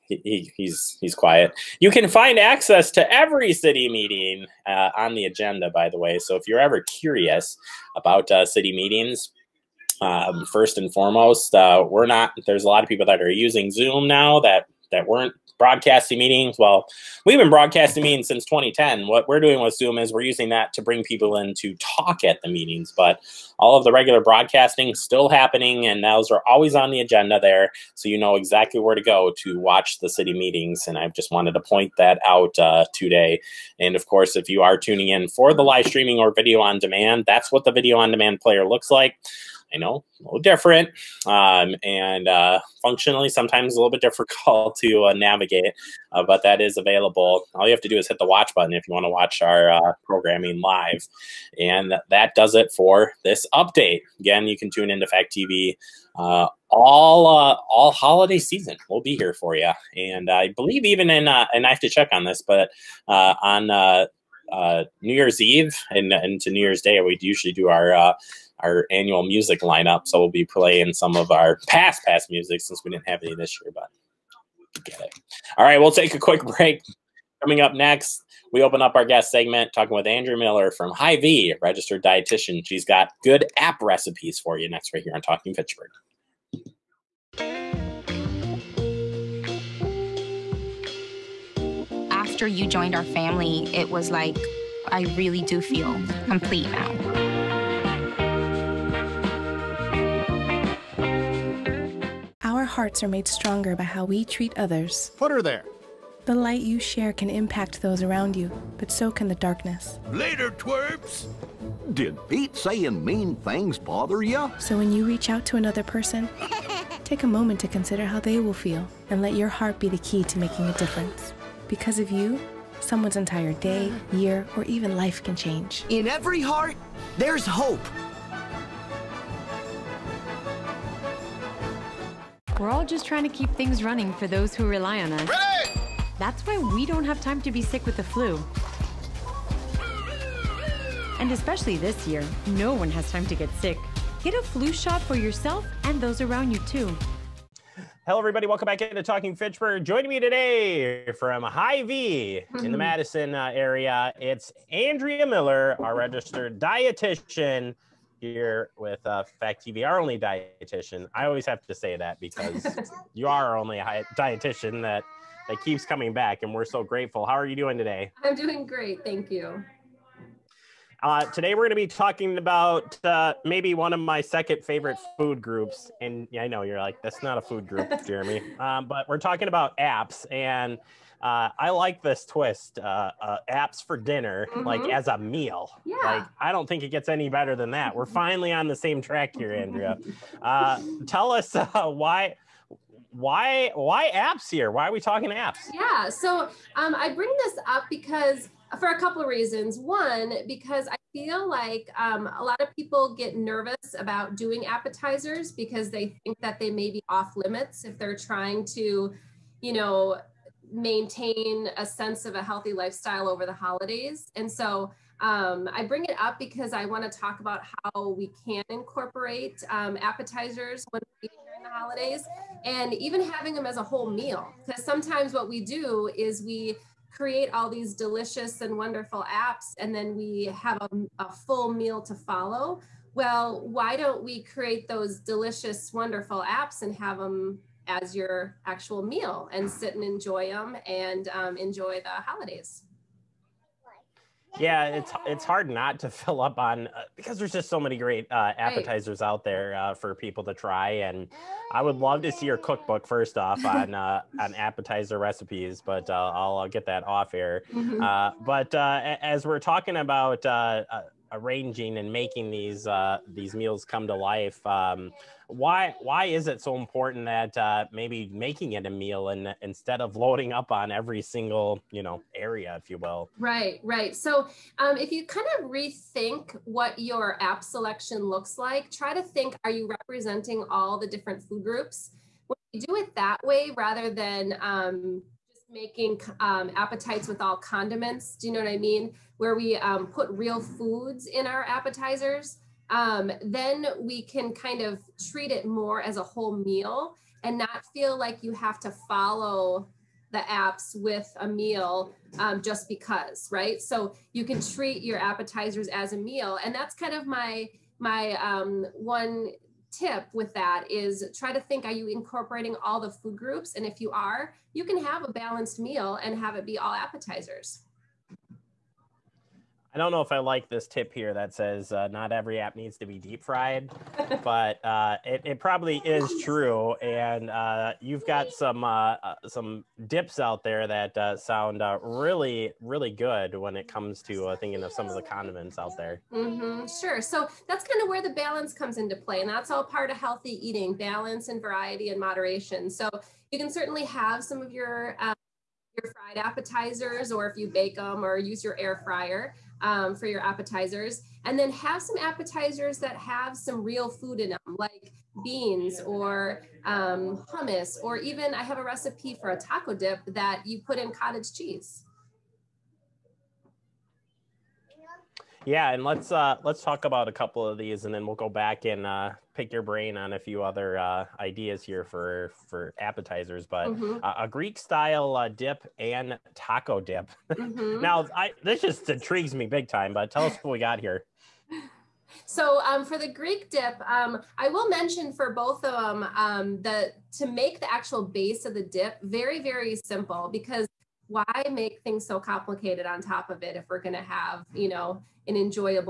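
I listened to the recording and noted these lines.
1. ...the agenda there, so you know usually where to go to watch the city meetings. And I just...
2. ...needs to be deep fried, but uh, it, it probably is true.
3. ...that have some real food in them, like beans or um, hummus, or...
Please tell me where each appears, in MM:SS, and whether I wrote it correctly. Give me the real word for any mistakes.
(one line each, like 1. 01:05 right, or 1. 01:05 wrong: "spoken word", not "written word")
1. 00:26 wrong: "exactly", not "usually"
2. 05:22 right
3. 05:52 right.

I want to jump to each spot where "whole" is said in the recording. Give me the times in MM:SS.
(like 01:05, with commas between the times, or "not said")
03:43, 04:56.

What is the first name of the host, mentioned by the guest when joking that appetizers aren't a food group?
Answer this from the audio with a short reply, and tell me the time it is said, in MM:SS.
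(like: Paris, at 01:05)
Jeremy, at 02:58.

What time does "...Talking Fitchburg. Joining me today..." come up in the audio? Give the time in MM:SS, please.
02:29.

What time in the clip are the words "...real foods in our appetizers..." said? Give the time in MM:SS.
04:50.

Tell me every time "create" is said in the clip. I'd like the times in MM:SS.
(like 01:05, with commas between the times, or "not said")
03:47, 03:54.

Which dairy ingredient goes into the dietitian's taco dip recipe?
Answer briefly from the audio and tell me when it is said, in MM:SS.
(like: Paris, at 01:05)
Cottage cheese, at 06:01.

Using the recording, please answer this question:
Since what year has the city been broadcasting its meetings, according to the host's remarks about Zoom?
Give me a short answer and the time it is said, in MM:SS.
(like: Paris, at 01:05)
2010, at 00:18.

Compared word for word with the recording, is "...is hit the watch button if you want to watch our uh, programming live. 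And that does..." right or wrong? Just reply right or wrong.
right.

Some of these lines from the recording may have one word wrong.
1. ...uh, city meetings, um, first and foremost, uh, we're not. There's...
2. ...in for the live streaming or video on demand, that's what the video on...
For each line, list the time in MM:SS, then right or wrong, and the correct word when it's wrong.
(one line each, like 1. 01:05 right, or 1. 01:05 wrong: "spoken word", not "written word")
1. 00:08 right
2. 00:35 right.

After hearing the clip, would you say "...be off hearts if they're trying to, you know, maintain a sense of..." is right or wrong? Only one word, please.
wrong.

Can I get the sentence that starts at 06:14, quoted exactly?
uh, a Greek style uh, dip and taco dip.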